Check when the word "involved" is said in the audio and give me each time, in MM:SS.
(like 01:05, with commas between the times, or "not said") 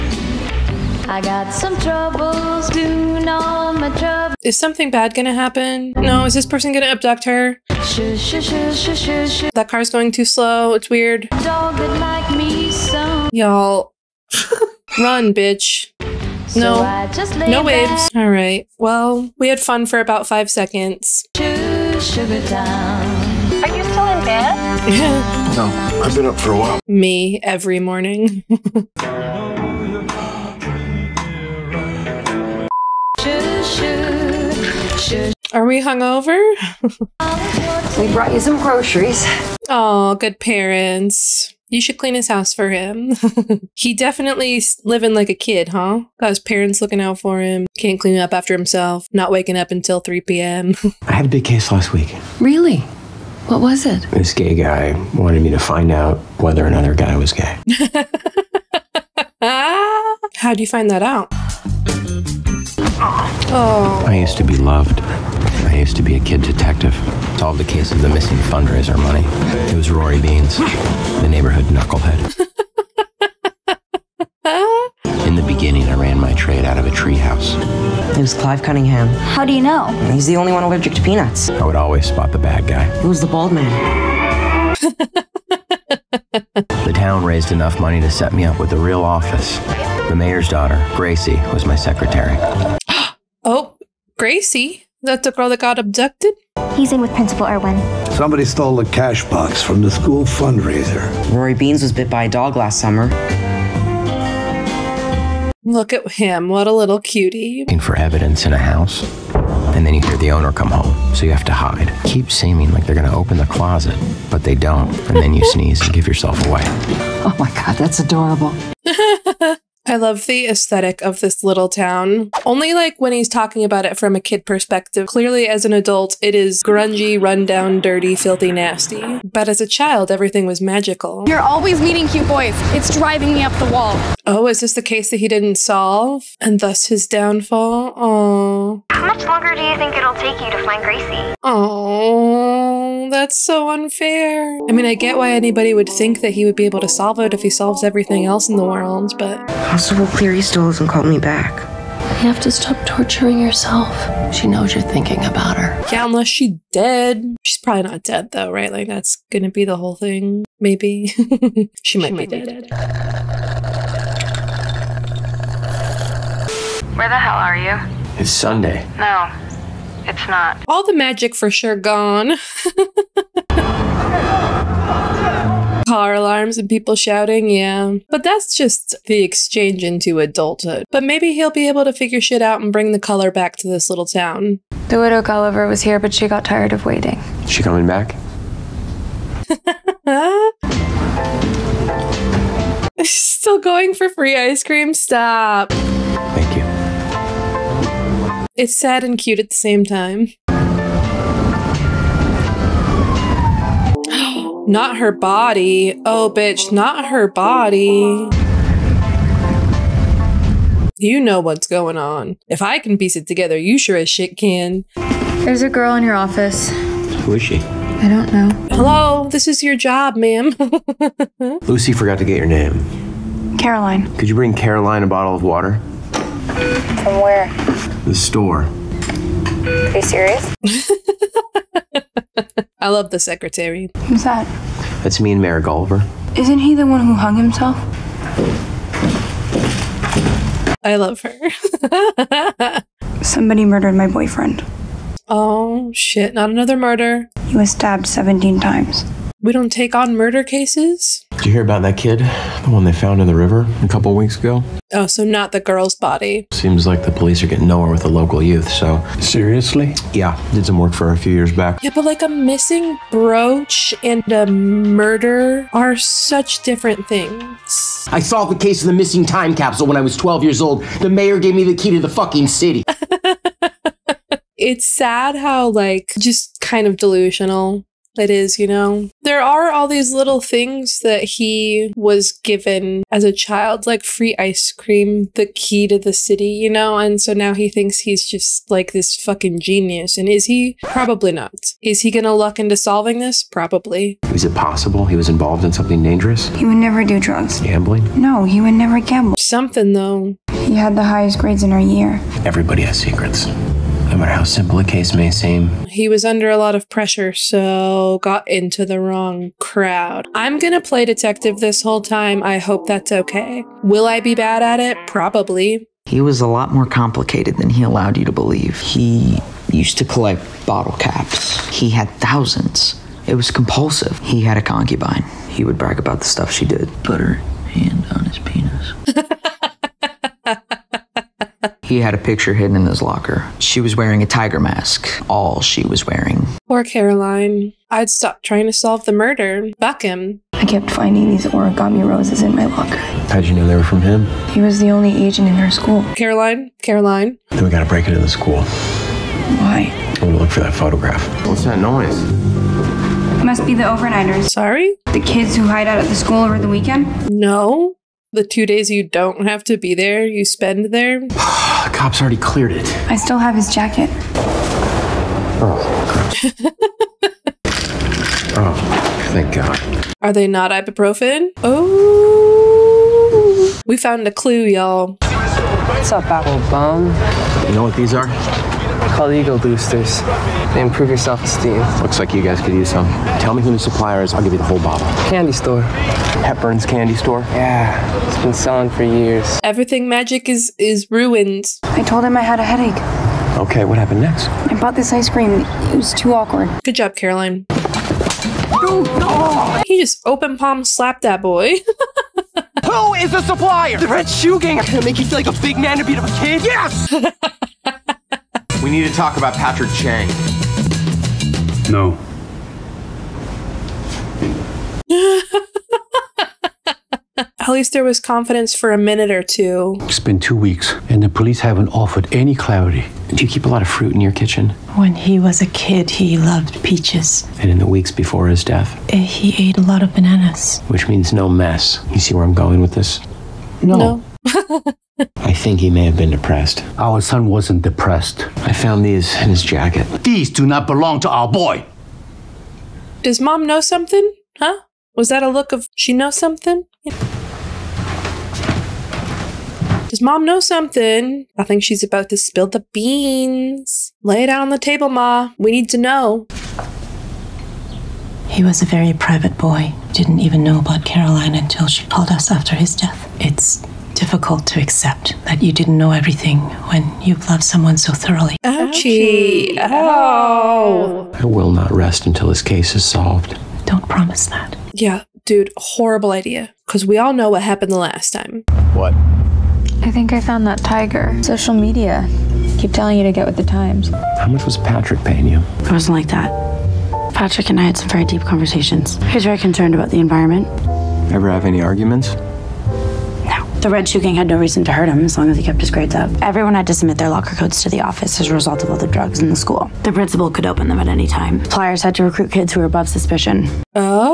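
04:55.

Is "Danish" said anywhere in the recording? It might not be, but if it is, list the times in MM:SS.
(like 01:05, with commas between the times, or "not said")
not said.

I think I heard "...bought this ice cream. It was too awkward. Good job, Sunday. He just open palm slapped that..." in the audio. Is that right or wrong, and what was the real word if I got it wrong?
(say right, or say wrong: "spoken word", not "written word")
wrong: "Caroline", not "Sunday".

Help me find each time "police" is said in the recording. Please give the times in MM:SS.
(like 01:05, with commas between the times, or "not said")
04:17, 07:01.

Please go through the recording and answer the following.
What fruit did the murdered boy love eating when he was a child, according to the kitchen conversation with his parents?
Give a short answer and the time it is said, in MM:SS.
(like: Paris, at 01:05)
Peaches, at 07:06.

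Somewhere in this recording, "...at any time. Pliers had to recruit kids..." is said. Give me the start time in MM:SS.
08:20.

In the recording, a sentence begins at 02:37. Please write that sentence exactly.
She's probably not dead, though, right?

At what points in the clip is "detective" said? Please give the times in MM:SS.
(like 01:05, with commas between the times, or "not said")
01:06, 05:11.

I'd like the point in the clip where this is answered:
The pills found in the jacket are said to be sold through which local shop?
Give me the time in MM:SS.
06:26.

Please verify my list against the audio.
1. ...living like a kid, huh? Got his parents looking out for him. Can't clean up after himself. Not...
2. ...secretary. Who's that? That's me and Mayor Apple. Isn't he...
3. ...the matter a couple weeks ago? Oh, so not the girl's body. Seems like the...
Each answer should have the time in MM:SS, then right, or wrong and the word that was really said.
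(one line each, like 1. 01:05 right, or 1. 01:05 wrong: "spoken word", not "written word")
1. 00:44 right
2. 03:53 wrong: "Gulliver", not "Apple"
3. 04:13 wrong: "river", not "matter".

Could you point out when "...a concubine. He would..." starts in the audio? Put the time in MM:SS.
05:24.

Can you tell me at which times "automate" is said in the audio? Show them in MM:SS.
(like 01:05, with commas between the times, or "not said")
not said.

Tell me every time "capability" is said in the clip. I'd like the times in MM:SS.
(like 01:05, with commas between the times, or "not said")
not said.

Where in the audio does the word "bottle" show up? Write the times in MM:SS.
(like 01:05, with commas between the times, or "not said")
03:45, 05:20, 06:24.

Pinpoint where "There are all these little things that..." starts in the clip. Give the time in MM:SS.
04:39.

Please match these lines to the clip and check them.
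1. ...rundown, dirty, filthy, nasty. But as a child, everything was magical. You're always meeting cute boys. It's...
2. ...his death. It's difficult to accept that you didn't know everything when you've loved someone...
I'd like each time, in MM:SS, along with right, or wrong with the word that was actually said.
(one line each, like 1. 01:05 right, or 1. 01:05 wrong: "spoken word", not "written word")
1. 02:07 right
2. 07:42 right.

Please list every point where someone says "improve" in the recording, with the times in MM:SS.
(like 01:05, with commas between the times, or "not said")
06:20.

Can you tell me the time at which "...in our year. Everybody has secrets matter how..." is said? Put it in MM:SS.
05:01.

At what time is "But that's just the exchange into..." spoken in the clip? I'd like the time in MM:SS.
02:58.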